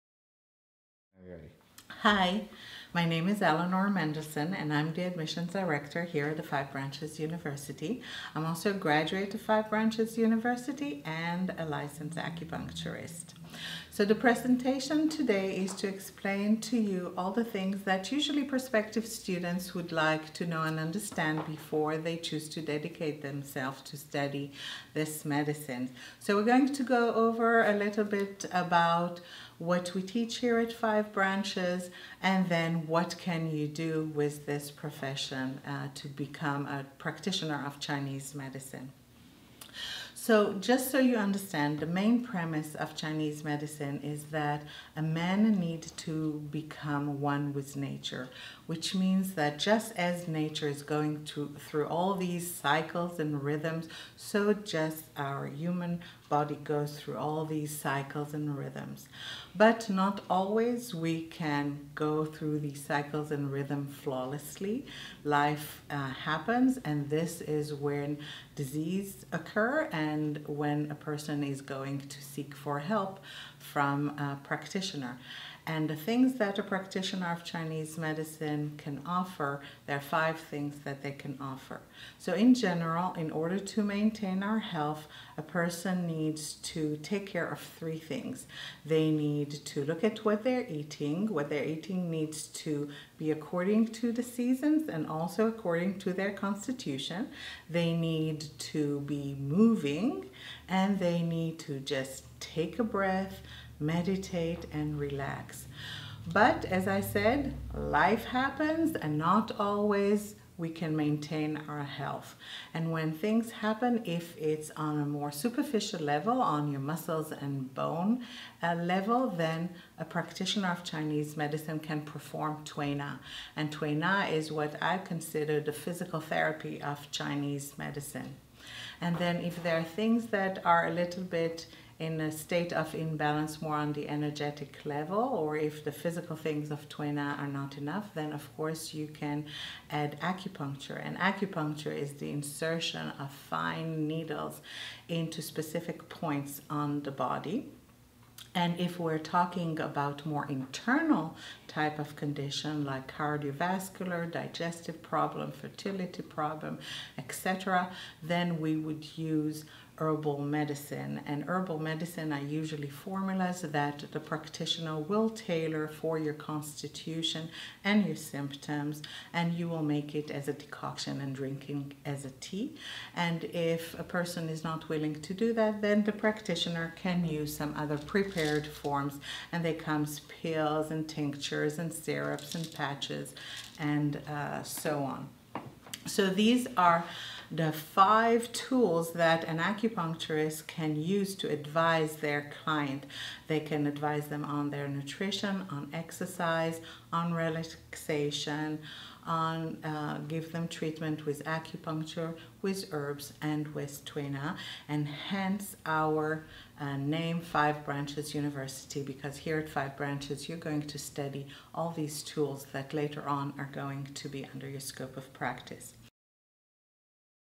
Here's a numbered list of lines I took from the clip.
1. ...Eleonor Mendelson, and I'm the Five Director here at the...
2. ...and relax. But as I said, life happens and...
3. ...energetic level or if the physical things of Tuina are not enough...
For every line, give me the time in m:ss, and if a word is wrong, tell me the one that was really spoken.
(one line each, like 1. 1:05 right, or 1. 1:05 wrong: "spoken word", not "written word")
1. 0:03 wrong: "Admissions", not "Five"
2. 1:44 right
3. 2:14 right.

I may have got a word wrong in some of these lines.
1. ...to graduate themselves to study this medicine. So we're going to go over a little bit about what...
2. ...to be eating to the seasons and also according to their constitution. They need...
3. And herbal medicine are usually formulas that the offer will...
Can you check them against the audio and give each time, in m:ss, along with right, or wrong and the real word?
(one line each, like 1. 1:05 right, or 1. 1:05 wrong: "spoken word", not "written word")
1. 0:22 wrong: "dedicate", not "graduate"
2. 1:32 wrong: "according", not "eating"
3. 2:41 wrong: "practitioner", not "offer".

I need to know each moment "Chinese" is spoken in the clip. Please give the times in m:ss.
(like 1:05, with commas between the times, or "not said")
0:37, 0:42, 1:17, 2:00, 2:07.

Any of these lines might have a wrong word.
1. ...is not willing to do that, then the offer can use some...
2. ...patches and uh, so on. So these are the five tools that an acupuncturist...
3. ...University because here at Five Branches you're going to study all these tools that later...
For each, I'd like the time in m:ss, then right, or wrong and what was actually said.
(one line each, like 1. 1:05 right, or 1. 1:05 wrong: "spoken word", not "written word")
1. 2:54 wrong: "practitioner", not "offer"
2. 3:02 right
3. 3:28 right.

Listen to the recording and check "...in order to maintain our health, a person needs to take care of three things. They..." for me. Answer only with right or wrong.
right.